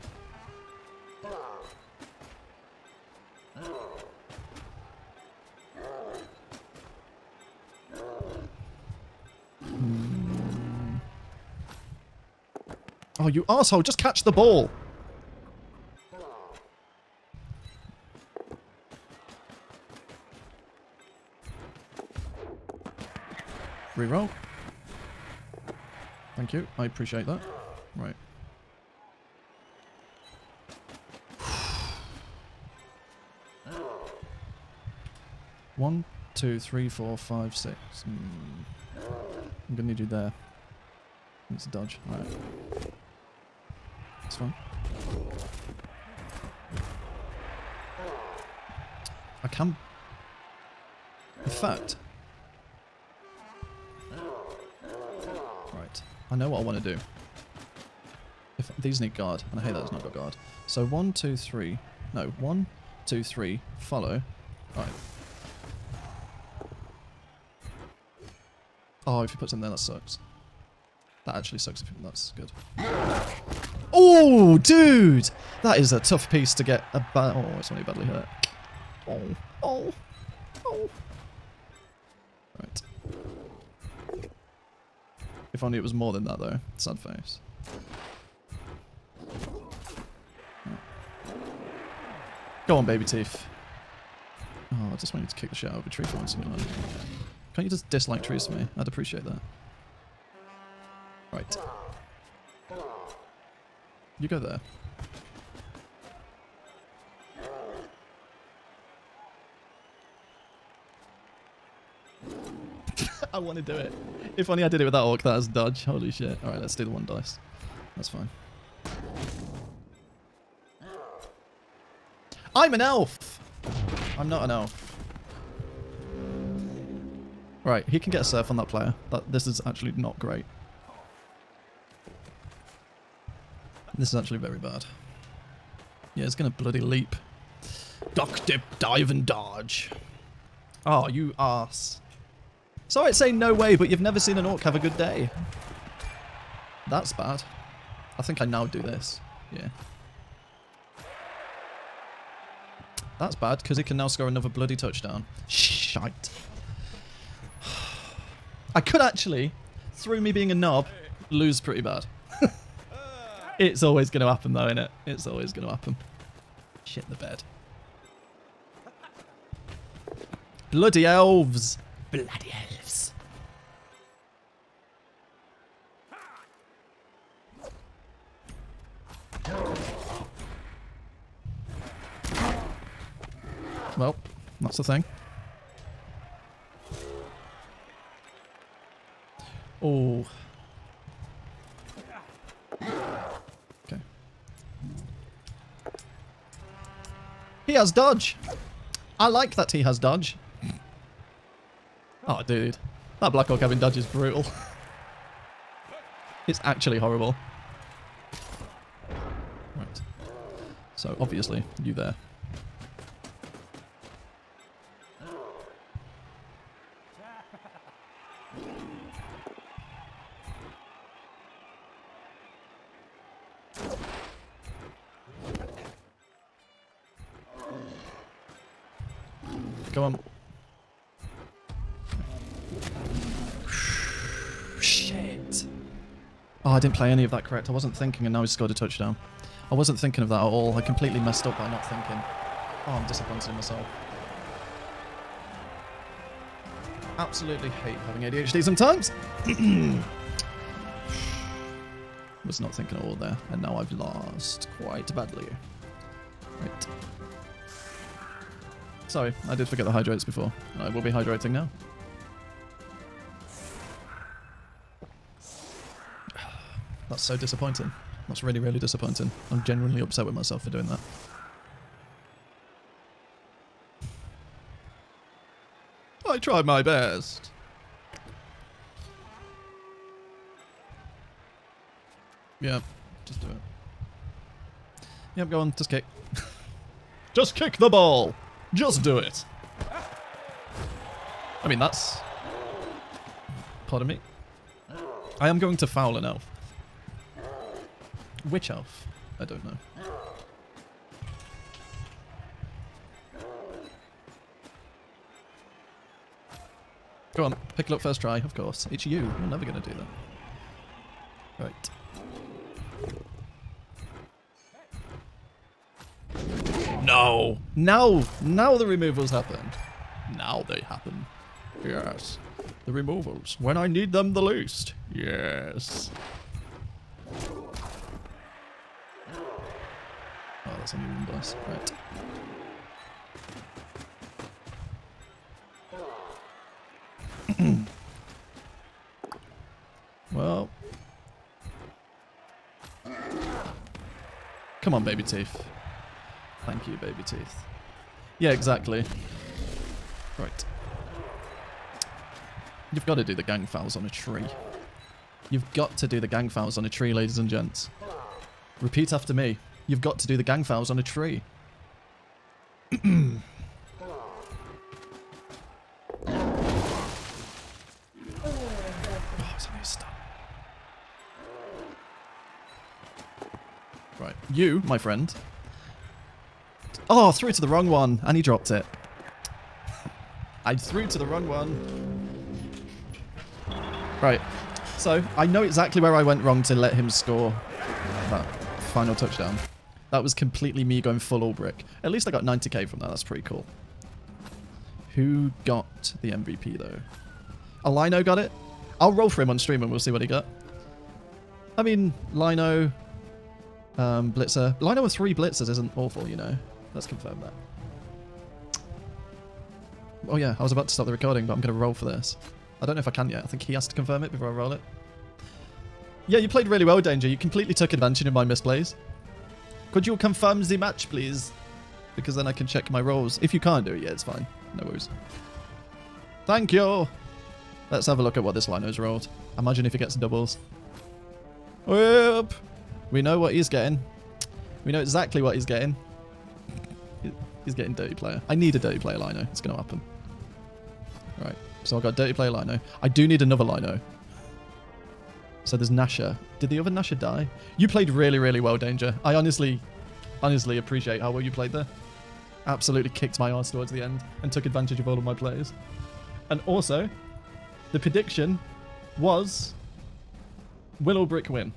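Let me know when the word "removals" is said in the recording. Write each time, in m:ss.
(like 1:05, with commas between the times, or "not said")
5:18, 5:22.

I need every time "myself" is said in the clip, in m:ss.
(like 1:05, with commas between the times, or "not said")
4:03, 4:30.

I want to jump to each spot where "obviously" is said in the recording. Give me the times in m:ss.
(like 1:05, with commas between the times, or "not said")
3:31.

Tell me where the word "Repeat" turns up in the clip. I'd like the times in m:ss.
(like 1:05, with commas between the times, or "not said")
5:58.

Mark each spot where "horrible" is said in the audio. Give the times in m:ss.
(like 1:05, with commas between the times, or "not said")
3:26.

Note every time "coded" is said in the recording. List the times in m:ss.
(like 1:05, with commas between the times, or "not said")
not said.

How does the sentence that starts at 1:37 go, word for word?
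Can't you just dislike trees for me?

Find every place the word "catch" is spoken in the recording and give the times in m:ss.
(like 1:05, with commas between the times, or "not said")
0:13.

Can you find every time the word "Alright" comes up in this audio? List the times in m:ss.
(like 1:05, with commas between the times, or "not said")
0:42, 1:04, 1:56.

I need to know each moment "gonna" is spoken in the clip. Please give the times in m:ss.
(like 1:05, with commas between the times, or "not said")
0:39, 2:16.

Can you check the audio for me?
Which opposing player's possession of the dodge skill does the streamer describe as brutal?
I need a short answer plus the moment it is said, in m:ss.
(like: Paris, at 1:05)
Black Hawk, at 3:23.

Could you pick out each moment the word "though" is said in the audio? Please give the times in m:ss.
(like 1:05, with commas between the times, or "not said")
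1:26, 2:44, 6:36.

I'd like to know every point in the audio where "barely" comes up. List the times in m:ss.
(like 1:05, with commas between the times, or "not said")
not said.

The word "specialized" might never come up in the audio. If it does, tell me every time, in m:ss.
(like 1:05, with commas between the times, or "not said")
not said.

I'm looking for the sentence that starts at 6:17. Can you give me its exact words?
Oh, threw to the wrong one.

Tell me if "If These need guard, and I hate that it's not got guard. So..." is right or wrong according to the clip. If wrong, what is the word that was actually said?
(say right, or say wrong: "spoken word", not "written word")
right.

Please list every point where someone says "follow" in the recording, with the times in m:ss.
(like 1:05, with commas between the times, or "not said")
1:03.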